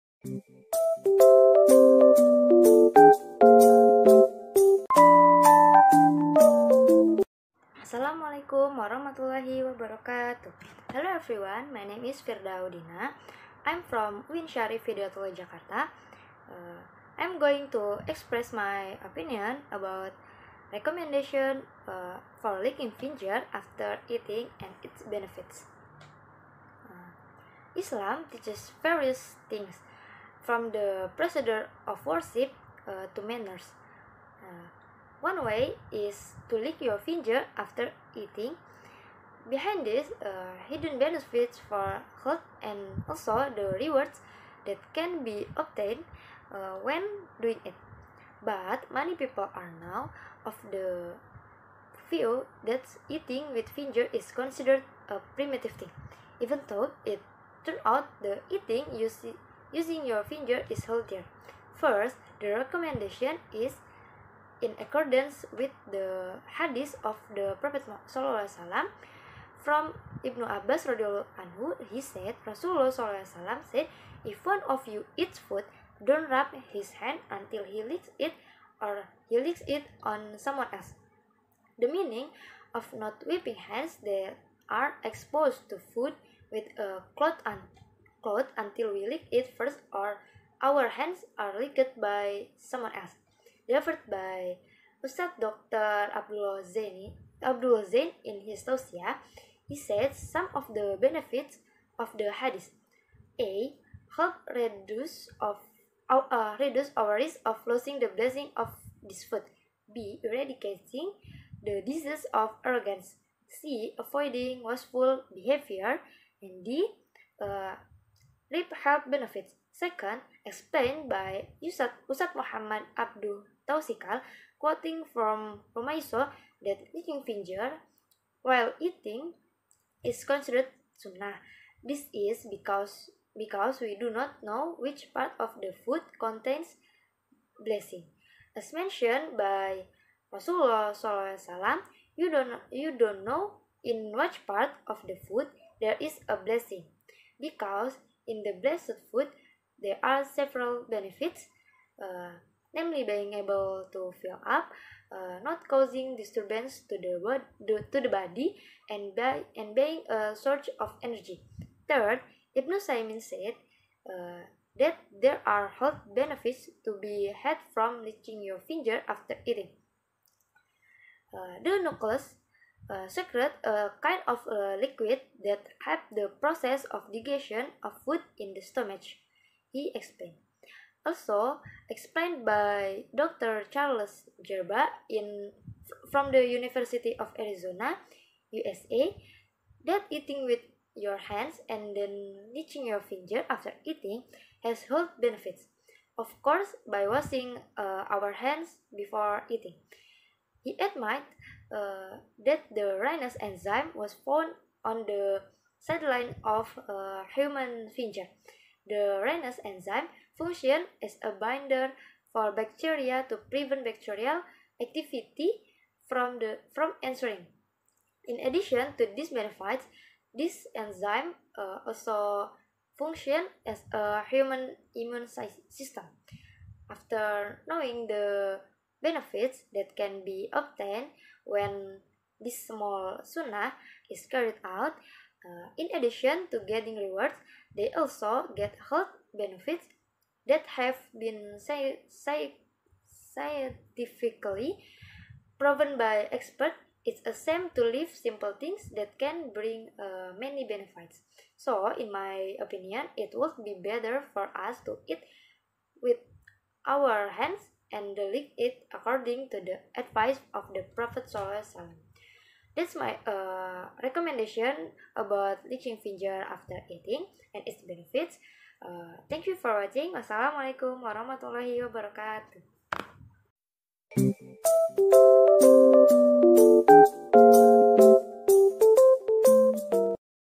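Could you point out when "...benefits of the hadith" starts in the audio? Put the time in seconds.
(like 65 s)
101 s.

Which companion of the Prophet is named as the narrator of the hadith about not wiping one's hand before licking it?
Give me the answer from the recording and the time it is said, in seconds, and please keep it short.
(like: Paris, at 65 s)
Ibnu Abbas, at 70 s.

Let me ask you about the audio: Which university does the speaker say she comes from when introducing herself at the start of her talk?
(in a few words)
Syarif Hidayatullah Jakarta.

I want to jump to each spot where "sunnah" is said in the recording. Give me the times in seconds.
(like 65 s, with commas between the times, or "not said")
130 s, 233 s.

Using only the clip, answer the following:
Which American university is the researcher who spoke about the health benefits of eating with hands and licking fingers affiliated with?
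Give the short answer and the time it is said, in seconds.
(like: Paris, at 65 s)
University of Arizona, at 186 s.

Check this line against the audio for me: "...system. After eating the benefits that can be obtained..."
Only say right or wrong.
wrong.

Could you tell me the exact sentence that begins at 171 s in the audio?
Uh, the nucleus secret a kind of a liquid that helps the process of digestion of food in the stomach, he explained.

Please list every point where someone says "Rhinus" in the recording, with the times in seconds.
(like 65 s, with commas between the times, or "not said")
203 s, 209 s.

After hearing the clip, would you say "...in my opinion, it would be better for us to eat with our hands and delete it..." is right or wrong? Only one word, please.
right.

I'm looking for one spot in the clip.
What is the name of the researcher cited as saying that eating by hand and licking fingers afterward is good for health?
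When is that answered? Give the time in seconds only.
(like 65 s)
183 s.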